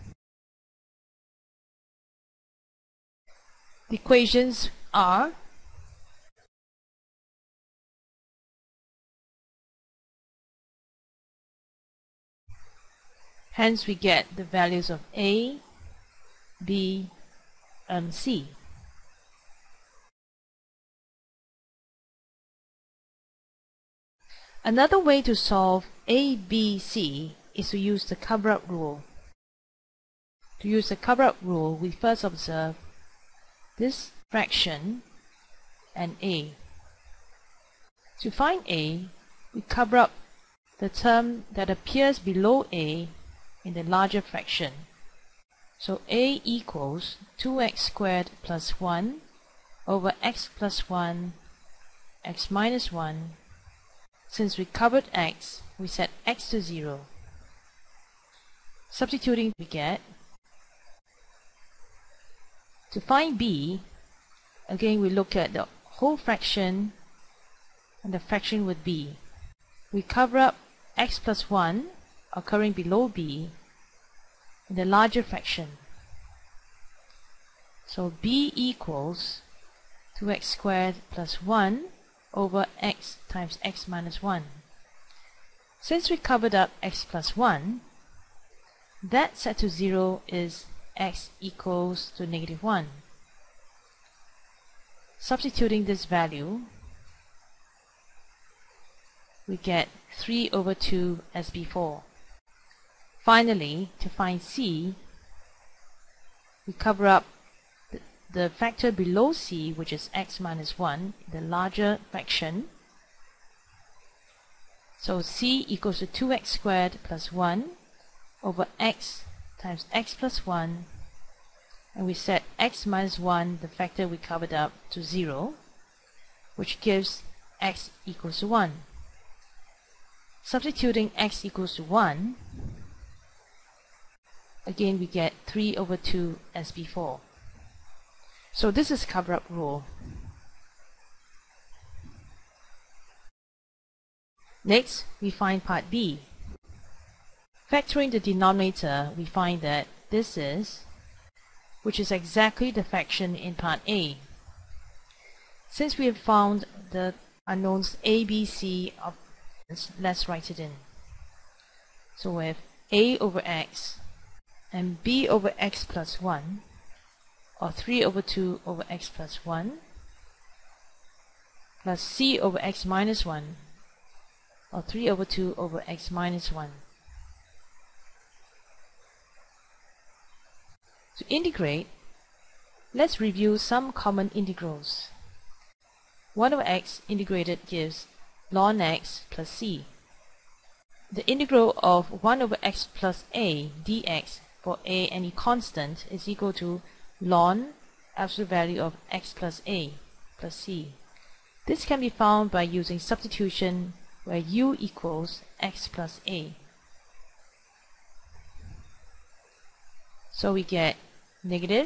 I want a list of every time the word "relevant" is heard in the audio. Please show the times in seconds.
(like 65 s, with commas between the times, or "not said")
not said.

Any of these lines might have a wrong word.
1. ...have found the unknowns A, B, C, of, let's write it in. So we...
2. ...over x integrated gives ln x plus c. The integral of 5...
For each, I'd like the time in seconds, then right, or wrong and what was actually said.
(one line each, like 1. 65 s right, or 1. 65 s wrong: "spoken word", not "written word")
1. 156 s right
2. 186 s wrong: "1", not "5".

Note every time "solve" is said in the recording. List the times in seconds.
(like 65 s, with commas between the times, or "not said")
25 s.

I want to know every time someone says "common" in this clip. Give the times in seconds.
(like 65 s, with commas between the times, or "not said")
183 s.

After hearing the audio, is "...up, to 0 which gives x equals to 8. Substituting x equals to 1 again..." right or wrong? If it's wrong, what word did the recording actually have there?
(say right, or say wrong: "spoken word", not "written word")
wrong: "1", not "8".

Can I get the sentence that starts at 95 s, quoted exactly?
Substituting this value, we get 3 over 2 as before.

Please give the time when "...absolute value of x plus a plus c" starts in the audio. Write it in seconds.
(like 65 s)
198 s.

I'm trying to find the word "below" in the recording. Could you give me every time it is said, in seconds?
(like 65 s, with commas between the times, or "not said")
42 s, 72 s, 108 s.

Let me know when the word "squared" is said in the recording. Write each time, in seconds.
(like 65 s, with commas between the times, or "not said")
47 s, 80 s, 116 s.